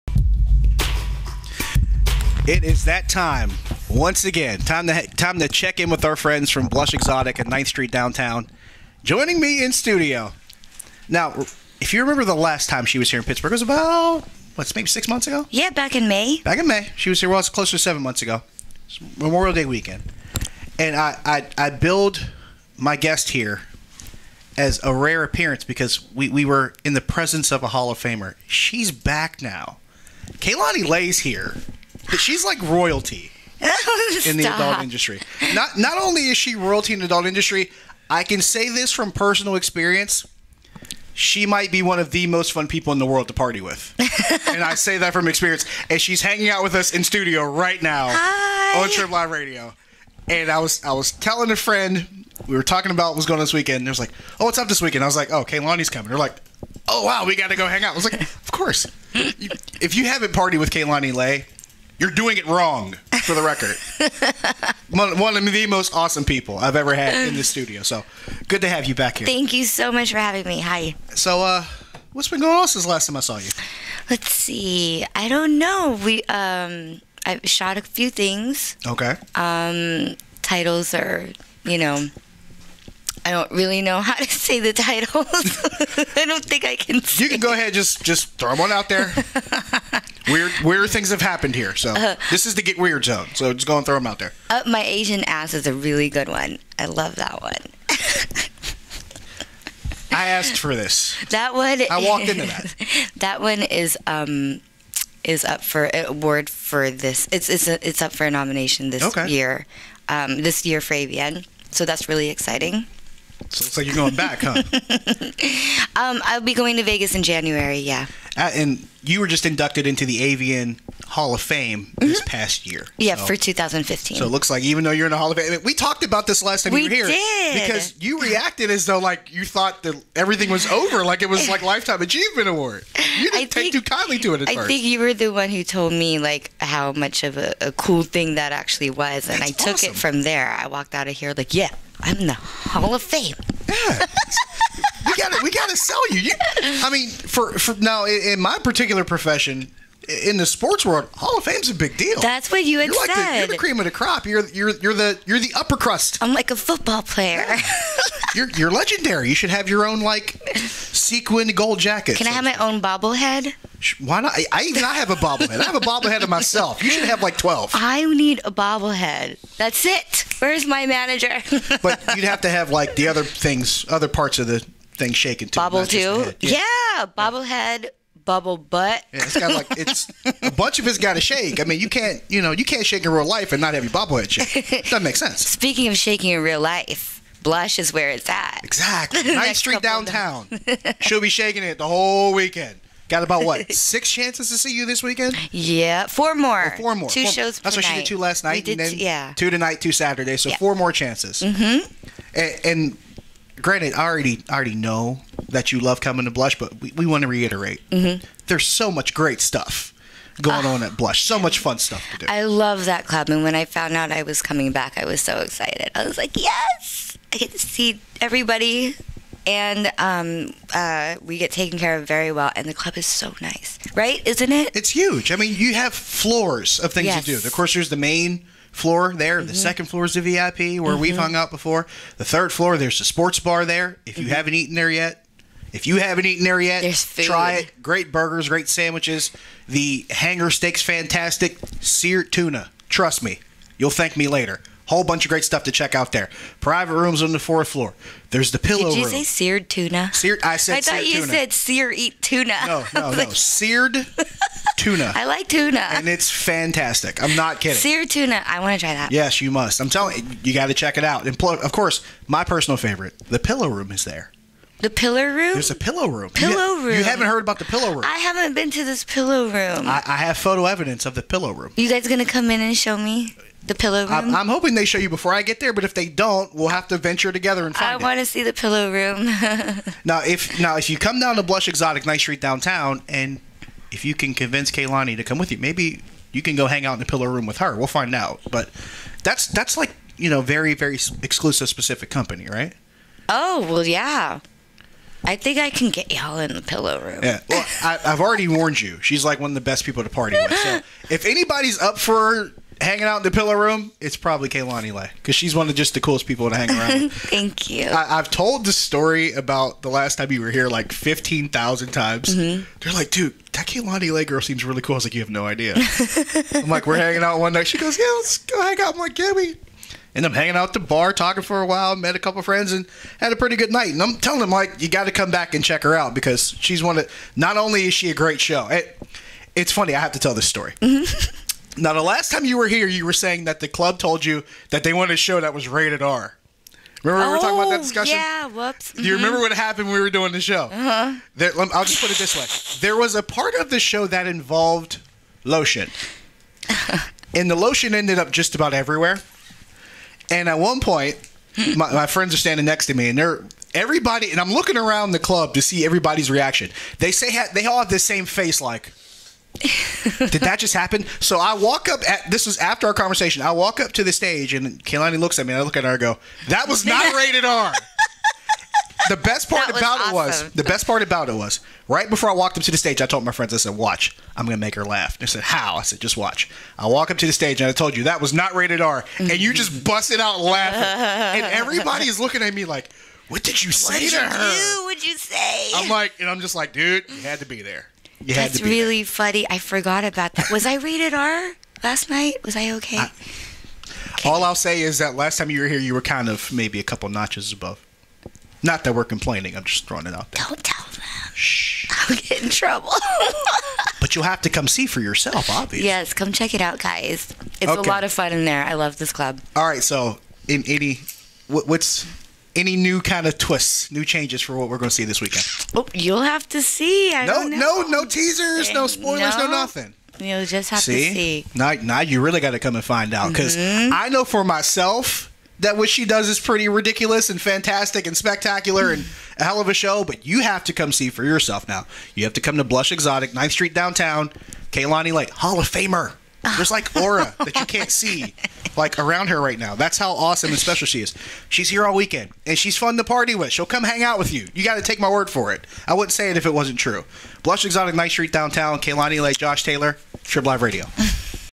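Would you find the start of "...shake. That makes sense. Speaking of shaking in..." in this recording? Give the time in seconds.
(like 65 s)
184 s.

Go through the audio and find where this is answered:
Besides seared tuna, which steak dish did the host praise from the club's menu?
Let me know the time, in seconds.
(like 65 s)
240 s.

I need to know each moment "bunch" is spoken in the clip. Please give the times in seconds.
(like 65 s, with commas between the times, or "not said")
180 s, 245 s.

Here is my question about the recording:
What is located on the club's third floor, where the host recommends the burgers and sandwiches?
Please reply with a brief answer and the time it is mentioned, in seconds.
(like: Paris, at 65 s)
sports bar, at 233 s.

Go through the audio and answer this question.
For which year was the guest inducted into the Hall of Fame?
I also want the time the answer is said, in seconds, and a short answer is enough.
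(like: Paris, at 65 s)
2015, at 123 s.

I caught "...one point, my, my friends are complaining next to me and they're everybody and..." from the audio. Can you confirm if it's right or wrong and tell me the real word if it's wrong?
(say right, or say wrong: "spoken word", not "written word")
wrong: "standing", not "complaining".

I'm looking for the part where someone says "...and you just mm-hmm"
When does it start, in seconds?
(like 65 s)
379 s.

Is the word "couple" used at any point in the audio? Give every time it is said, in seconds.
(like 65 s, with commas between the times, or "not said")
322 s, 396 s.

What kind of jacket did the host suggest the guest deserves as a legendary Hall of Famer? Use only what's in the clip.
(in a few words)
sequined gold jacket.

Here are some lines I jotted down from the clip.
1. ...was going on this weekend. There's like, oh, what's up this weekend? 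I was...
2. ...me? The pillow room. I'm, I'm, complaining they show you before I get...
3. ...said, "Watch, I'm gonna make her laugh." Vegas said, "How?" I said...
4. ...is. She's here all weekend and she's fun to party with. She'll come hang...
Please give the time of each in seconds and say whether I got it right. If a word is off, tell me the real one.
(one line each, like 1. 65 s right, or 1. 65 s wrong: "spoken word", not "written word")
1. 53 s right
2. 272 s wrong: "hoping", not "complaining"
3. 373 s wrong: "They", not "Vegas"
4. 441 s right.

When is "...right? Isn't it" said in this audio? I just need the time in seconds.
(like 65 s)
223 s.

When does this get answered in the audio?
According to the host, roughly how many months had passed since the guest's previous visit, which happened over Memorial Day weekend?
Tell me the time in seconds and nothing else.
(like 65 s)
17 s.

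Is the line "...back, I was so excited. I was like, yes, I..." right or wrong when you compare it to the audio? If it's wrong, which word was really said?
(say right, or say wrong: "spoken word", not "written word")
right.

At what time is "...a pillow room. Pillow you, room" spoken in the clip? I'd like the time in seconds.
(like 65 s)
265 s.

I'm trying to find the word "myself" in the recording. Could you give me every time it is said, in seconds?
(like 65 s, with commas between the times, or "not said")
166 s, 424 s.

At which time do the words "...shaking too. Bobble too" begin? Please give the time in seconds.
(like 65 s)
175 s.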